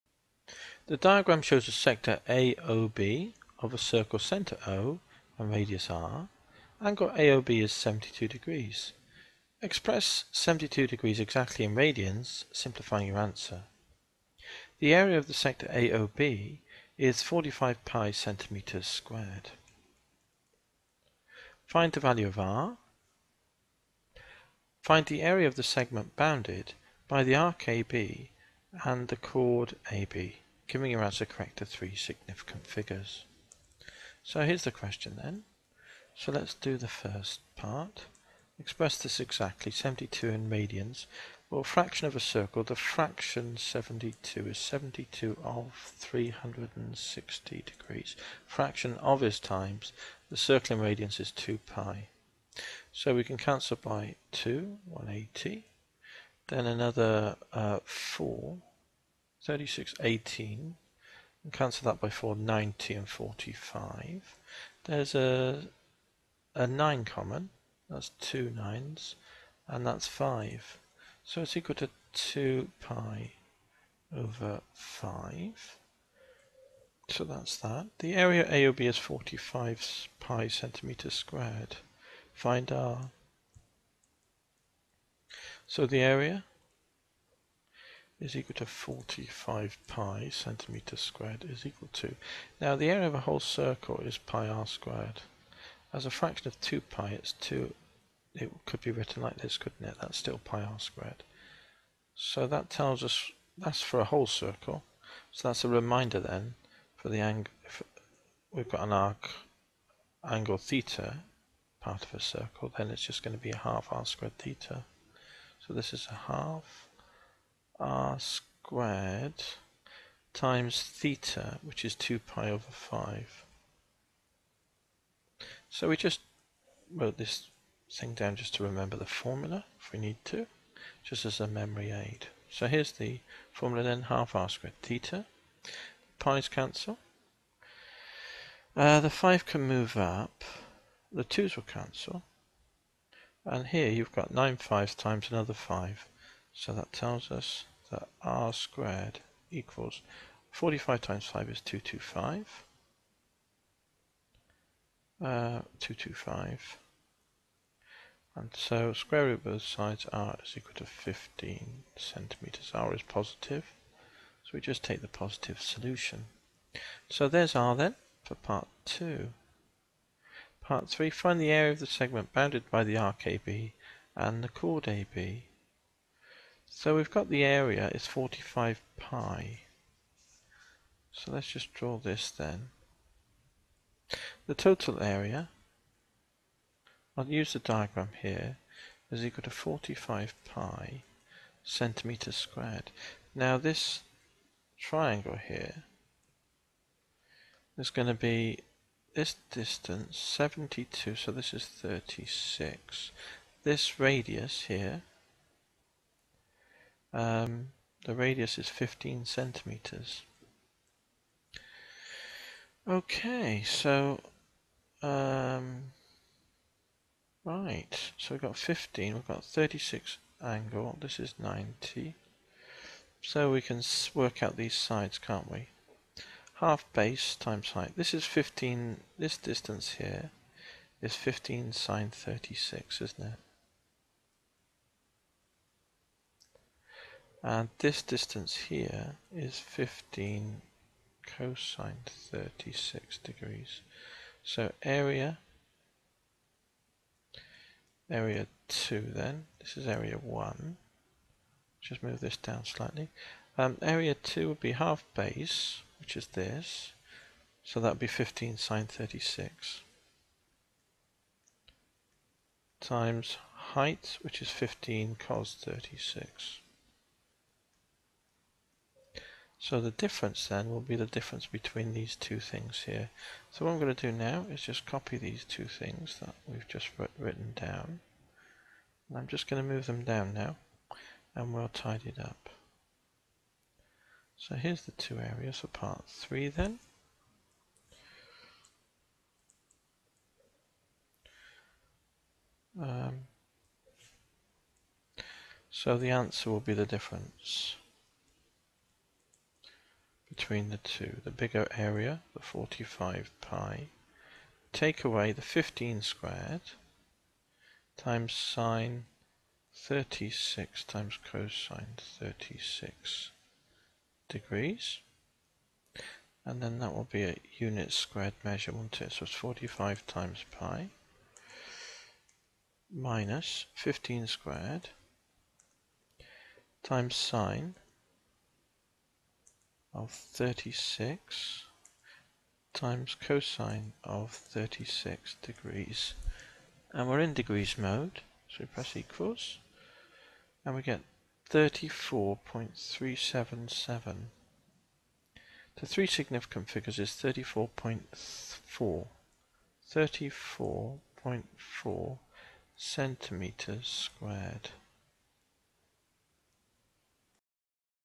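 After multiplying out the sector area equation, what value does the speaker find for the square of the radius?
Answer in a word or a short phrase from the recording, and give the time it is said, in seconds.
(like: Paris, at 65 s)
225, at 150 s.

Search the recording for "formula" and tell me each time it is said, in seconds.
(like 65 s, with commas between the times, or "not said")
129 s, 133 s.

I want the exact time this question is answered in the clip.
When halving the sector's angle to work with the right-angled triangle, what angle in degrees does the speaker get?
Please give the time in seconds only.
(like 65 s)
201 s.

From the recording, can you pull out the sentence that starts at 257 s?
So that would be 15 sine 36 times height, which is 15 cos 36.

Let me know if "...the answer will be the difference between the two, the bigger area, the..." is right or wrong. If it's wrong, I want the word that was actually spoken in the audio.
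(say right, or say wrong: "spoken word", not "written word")
right.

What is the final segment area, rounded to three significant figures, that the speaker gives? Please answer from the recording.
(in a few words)
34.4 cm².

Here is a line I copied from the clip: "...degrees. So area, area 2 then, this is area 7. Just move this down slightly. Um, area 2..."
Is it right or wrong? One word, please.
wrong.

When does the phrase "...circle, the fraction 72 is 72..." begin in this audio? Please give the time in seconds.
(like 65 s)
42 s.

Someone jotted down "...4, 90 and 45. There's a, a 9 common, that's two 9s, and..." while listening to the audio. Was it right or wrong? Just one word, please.
right.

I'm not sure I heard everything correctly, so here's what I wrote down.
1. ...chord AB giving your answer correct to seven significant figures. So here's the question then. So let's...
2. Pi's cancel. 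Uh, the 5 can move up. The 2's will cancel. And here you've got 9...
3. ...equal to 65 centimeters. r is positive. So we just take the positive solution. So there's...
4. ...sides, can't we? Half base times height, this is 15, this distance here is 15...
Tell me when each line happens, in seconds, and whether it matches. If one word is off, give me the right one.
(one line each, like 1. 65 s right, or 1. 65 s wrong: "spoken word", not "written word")
1. 29 s wrong: "three", not "seven"
2. 136 s right
3. 160 s wrong: "15", not "65"
4. 224 s right.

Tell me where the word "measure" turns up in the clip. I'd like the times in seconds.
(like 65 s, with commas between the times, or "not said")
318 s.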